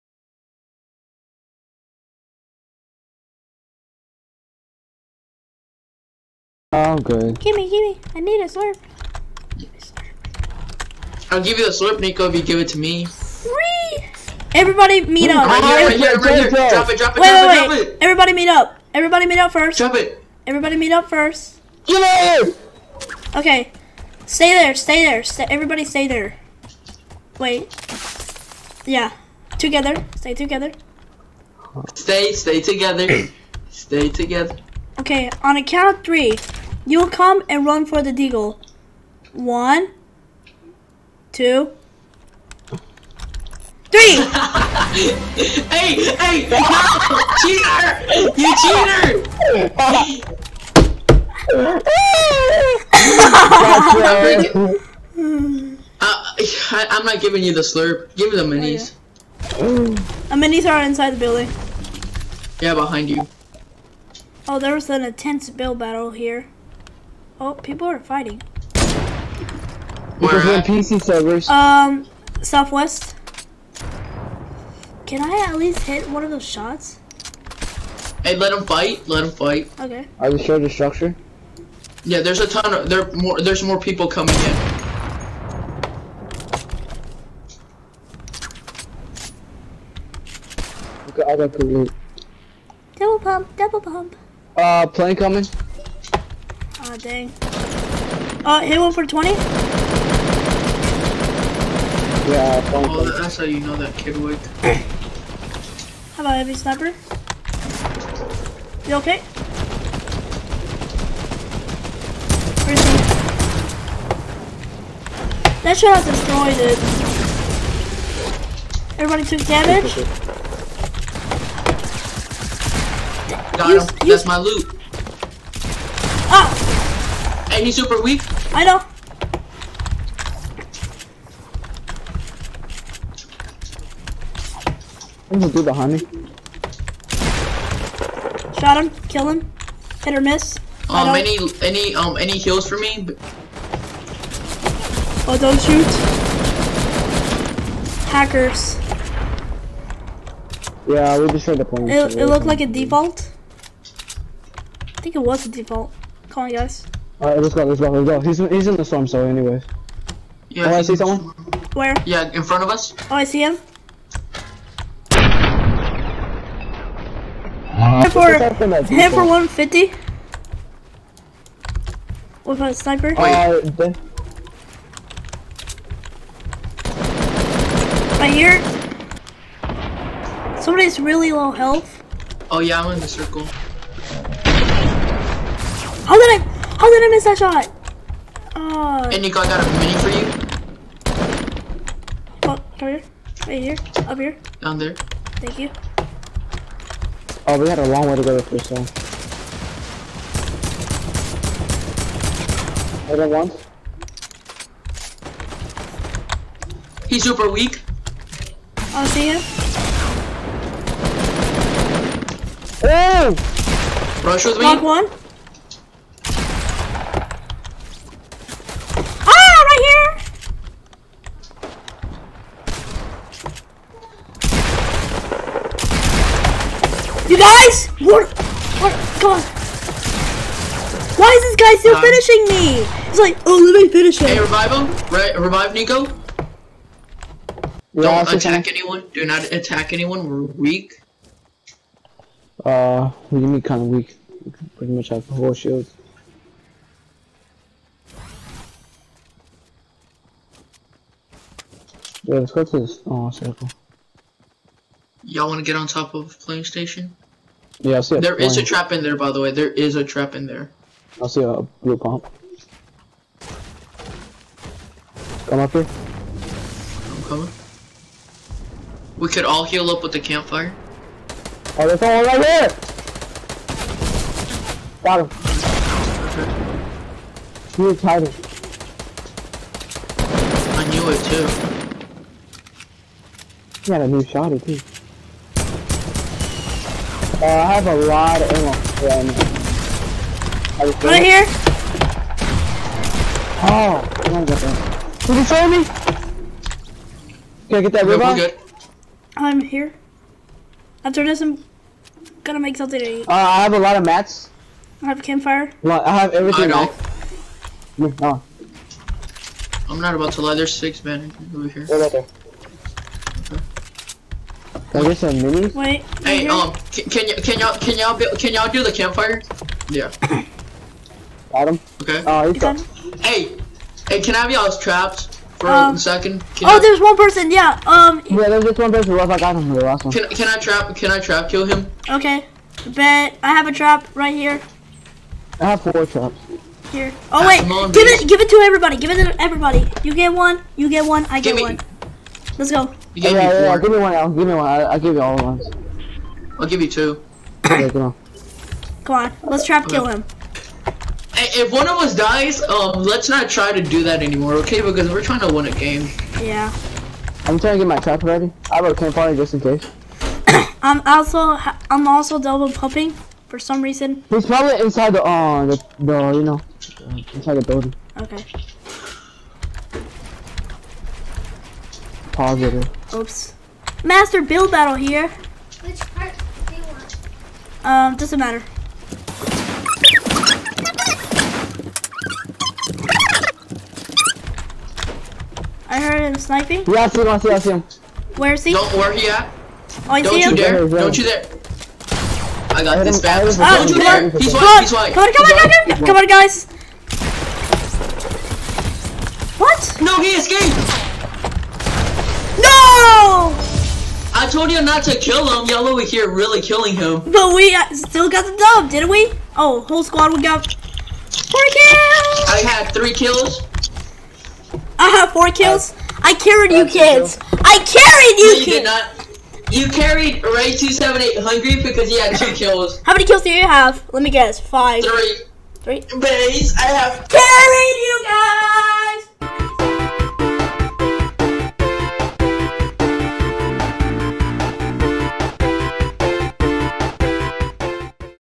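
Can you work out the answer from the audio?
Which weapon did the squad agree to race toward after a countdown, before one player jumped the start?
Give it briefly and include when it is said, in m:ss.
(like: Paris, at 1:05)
deagle, at 0:38.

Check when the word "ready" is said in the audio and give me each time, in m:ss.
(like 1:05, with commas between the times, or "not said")
5:58.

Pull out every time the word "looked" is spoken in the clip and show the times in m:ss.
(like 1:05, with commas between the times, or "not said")
2:32.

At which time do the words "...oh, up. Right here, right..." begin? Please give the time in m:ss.
0:15.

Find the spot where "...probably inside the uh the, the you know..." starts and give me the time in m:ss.
6:04.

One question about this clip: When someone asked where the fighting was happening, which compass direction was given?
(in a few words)
southwest.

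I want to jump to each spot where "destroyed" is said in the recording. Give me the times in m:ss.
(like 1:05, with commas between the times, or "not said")
1:56, 2:31.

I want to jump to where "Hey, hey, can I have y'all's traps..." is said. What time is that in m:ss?
5:23.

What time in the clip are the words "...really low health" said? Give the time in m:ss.
3:00.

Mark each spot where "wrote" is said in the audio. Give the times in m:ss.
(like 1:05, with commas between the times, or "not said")
5:58.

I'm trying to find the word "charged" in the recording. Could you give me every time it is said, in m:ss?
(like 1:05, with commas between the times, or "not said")
not said.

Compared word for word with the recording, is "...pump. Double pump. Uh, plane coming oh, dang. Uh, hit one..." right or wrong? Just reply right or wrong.
right.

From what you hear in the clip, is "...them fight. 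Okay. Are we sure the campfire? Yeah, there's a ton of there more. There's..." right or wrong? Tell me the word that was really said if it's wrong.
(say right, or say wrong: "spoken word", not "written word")
wrong: "structure", not "campfire".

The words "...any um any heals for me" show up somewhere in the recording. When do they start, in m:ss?
2:21.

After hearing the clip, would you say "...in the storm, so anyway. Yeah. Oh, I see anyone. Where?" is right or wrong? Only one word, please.
wrong.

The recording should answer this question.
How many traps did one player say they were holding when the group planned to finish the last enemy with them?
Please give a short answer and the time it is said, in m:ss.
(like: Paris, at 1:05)
4, at 5:35.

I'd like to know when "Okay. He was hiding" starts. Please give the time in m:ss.
4:36.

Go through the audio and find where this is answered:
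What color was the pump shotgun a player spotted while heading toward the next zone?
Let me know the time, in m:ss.
4:21.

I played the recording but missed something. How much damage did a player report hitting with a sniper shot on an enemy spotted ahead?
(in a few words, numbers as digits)
150.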